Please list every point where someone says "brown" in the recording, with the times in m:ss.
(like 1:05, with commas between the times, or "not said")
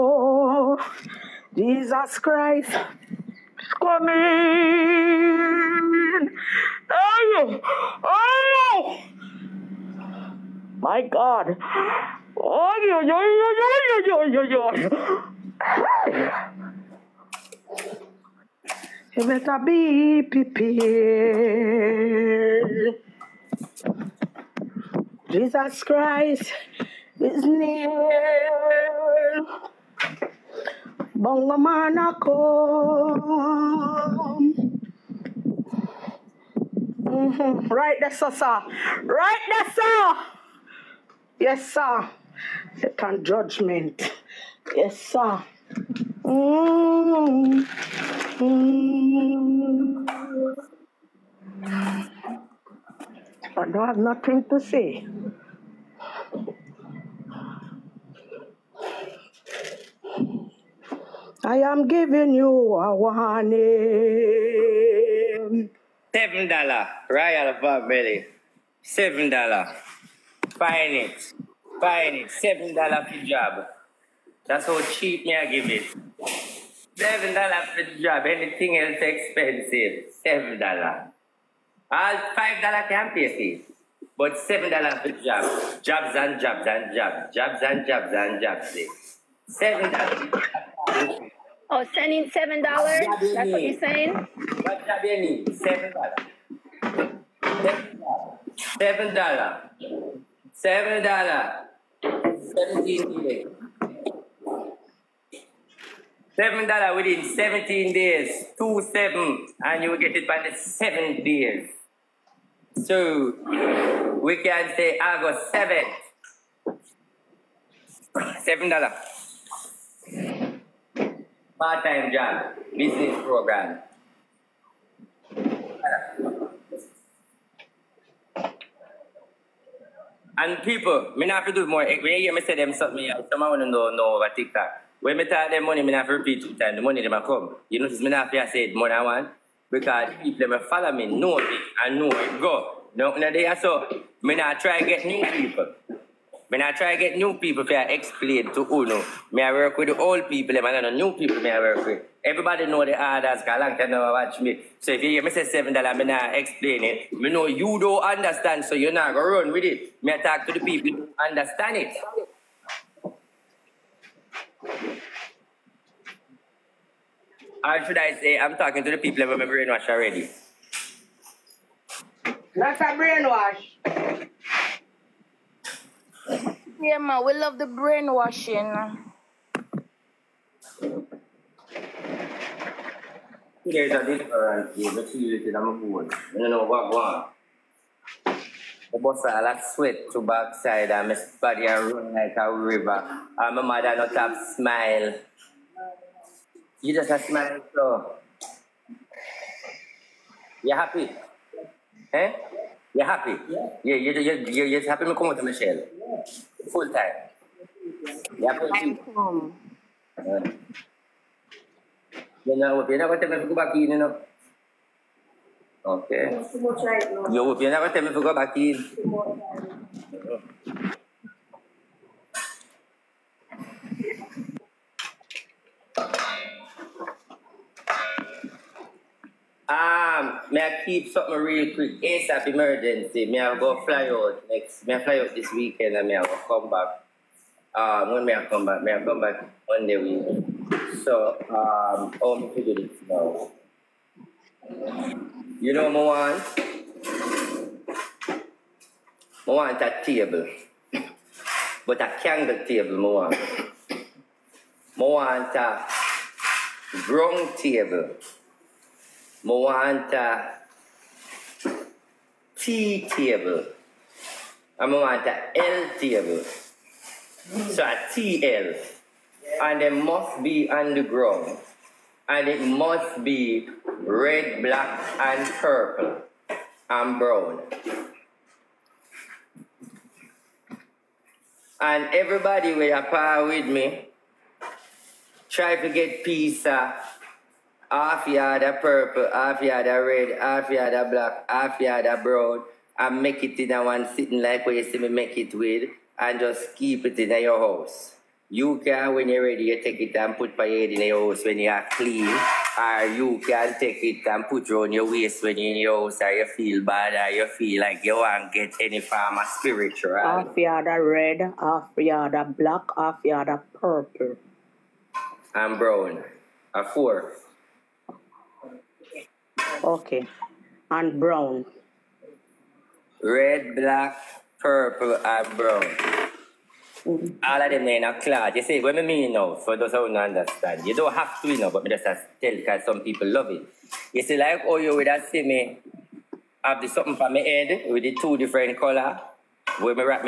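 4:37, 4:52, 5:15, 5:21, 5:25.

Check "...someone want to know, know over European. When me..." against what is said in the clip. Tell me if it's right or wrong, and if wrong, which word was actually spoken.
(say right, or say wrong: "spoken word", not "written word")
wrong: "TikTok", not "European".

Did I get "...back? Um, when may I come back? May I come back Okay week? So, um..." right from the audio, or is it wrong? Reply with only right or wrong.
wrong.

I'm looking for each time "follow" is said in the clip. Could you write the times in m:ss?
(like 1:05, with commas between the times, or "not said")
2:20.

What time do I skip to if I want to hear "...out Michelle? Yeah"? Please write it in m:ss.
3:25.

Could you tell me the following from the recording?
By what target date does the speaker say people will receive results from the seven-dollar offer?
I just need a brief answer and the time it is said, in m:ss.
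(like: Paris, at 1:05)
August 7, at 1:54.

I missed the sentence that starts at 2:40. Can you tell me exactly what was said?
Me talk to the people who understand it.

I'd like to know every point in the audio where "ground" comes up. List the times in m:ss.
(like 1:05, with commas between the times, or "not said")
4:17, 4:31.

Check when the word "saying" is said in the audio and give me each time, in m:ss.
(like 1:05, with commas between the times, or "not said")
1:33.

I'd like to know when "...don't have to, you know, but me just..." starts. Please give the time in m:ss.
5:30.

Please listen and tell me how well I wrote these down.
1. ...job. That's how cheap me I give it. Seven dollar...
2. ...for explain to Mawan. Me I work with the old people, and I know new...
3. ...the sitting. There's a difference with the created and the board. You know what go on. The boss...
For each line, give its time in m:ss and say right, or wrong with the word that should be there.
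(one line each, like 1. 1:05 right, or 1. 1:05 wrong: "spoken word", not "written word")
1. 1:13 right
2. 2:27 wrong: "Uno", not "Mawan"
3. 2:57 wrong: "brainwashing", not "sitting".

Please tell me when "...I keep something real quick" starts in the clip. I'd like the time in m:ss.
3:50.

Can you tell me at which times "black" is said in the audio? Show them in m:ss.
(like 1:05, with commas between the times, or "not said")
4:34, 4:51, 5:12, 5:23.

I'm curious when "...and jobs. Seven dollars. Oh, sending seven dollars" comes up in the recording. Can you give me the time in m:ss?
1:28.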